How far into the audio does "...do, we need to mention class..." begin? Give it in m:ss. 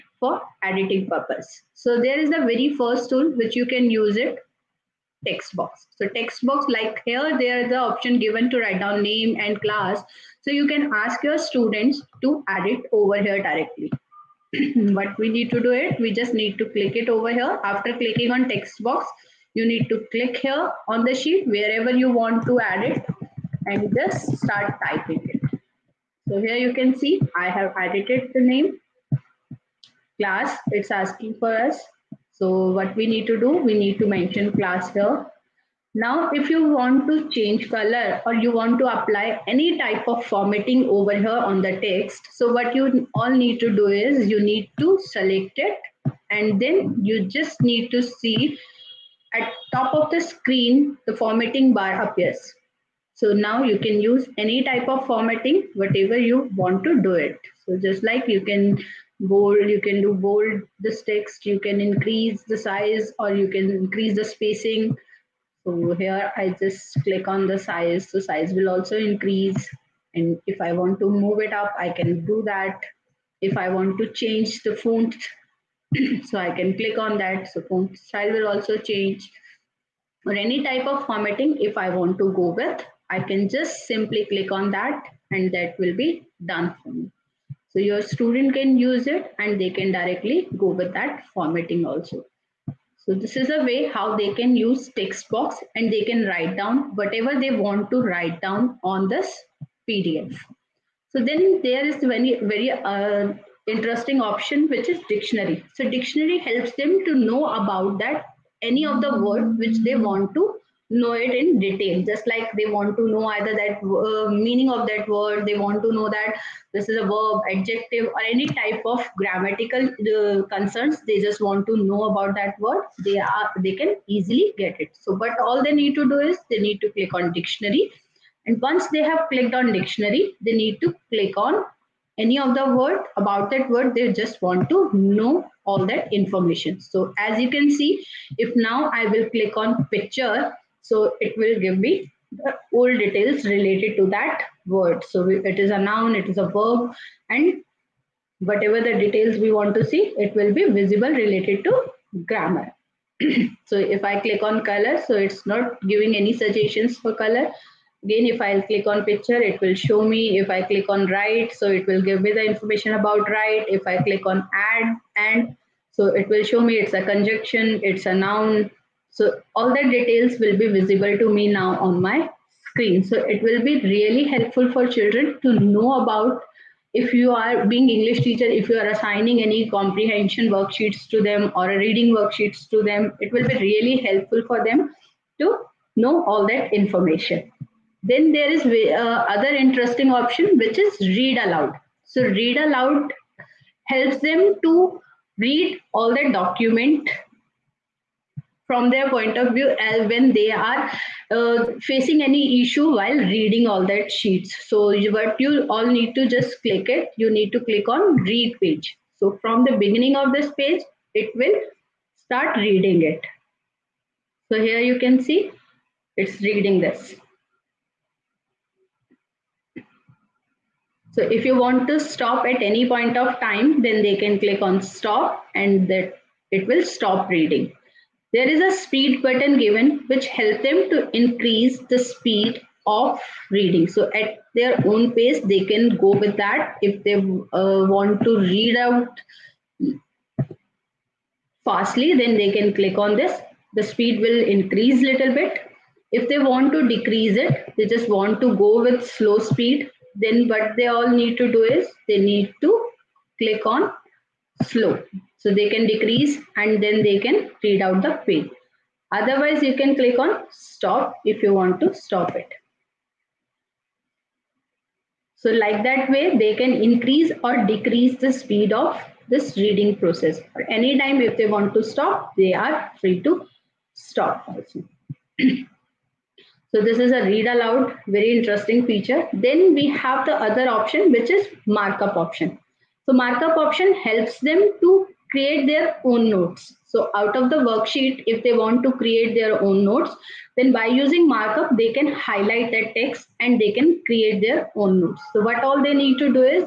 0:33.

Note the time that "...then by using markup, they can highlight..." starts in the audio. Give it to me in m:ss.
4:50.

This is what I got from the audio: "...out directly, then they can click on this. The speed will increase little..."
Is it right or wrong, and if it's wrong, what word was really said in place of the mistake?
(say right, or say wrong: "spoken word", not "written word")
wrong: "fastly", not "directly".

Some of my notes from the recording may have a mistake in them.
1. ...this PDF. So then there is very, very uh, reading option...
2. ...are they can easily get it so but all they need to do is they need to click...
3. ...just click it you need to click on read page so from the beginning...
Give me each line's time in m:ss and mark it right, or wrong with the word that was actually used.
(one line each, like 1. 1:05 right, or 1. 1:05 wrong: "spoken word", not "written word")
1. 1:39 wrong: "interesting", not "reading"
2. 2:03 right
3. 3:26 right.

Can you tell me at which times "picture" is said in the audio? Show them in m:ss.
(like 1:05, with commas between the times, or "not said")
2:19, 2:39.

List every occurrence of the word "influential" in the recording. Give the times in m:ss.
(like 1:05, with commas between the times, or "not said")
not said.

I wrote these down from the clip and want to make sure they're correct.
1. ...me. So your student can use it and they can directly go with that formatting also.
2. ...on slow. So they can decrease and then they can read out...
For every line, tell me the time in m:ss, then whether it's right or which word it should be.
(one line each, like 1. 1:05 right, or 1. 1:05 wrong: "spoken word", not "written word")
1. 1:26 right
2. 4:13 right.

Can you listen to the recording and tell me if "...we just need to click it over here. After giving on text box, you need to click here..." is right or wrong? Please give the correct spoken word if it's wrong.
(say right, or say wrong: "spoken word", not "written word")
wrong: "clicking", not "giving".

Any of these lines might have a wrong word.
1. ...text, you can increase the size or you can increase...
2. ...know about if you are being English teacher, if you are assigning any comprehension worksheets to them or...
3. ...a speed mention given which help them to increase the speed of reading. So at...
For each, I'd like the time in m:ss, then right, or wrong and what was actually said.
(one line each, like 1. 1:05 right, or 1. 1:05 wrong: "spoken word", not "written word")
1. 1:01 right
2. 2:55 right
3. 3:48 wrong: "button", not "mention".